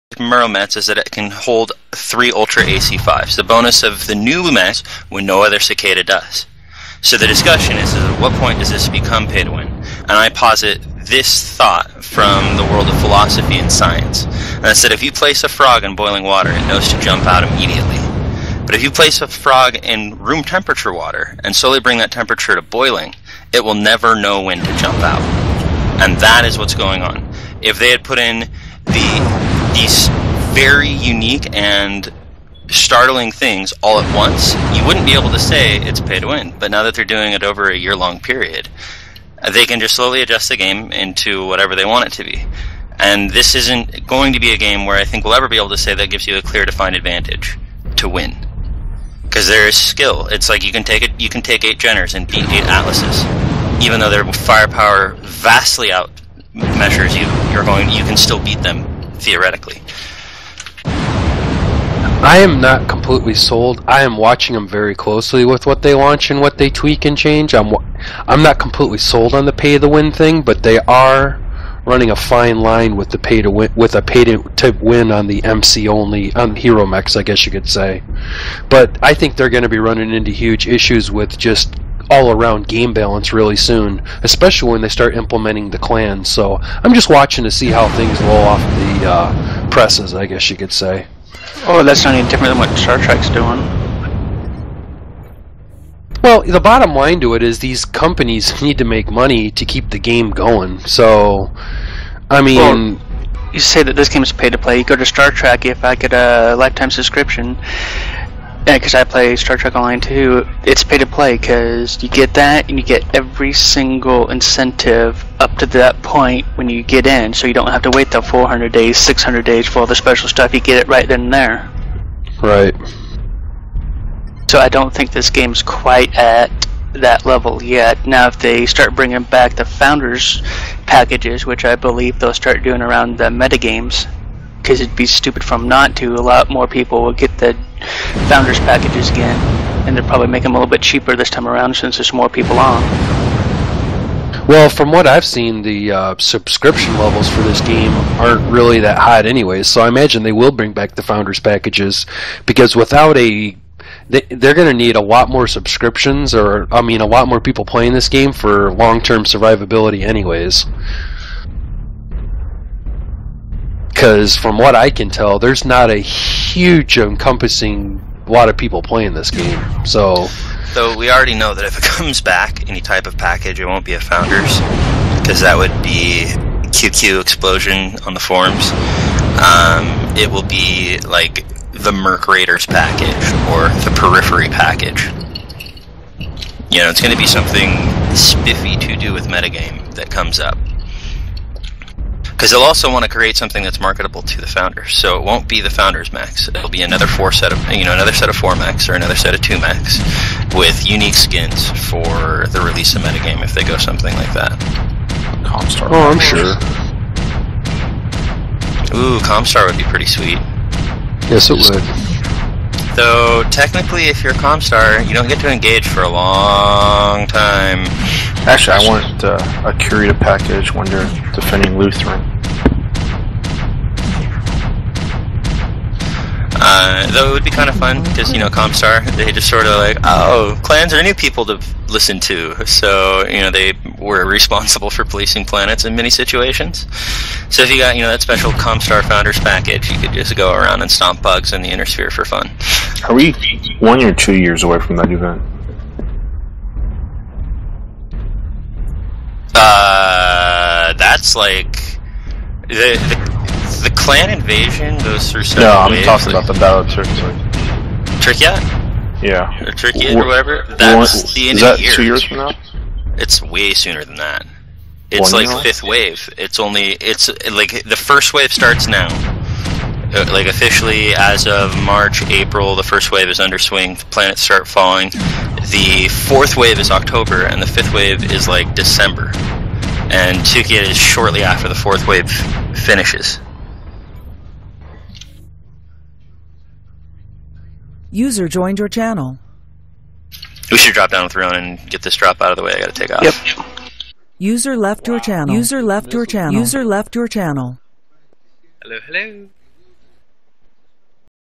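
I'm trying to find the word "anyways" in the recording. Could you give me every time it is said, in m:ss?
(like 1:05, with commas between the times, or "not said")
2:29, 2:40.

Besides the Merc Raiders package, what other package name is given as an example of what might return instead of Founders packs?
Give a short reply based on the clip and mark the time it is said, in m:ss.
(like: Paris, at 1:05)
Periphery package, at 3:03.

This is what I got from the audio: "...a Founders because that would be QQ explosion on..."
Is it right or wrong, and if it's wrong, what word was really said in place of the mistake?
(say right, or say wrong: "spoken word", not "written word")
right.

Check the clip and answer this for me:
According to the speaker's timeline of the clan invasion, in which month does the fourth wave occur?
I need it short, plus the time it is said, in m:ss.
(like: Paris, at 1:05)
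October, at 4:36.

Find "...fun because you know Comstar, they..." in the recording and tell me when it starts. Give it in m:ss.
3:47.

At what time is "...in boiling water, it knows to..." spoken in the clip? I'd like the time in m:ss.
0:15.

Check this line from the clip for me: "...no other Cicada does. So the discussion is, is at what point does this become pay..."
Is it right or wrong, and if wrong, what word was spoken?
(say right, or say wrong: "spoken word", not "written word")
right.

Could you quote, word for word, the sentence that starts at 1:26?
So I'm just watching to see how things roll off the uh, presses, I guess you could say.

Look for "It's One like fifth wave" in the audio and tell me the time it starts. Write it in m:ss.
4:25.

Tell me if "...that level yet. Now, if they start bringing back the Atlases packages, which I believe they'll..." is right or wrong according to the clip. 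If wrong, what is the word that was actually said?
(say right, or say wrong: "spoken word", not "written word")
wrong: "Founders", not "Atlases".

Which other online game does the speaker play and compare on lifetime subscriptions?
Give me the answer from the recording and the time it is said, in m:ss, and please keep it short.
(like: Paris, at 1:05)
Star Trek Online, at 1:49.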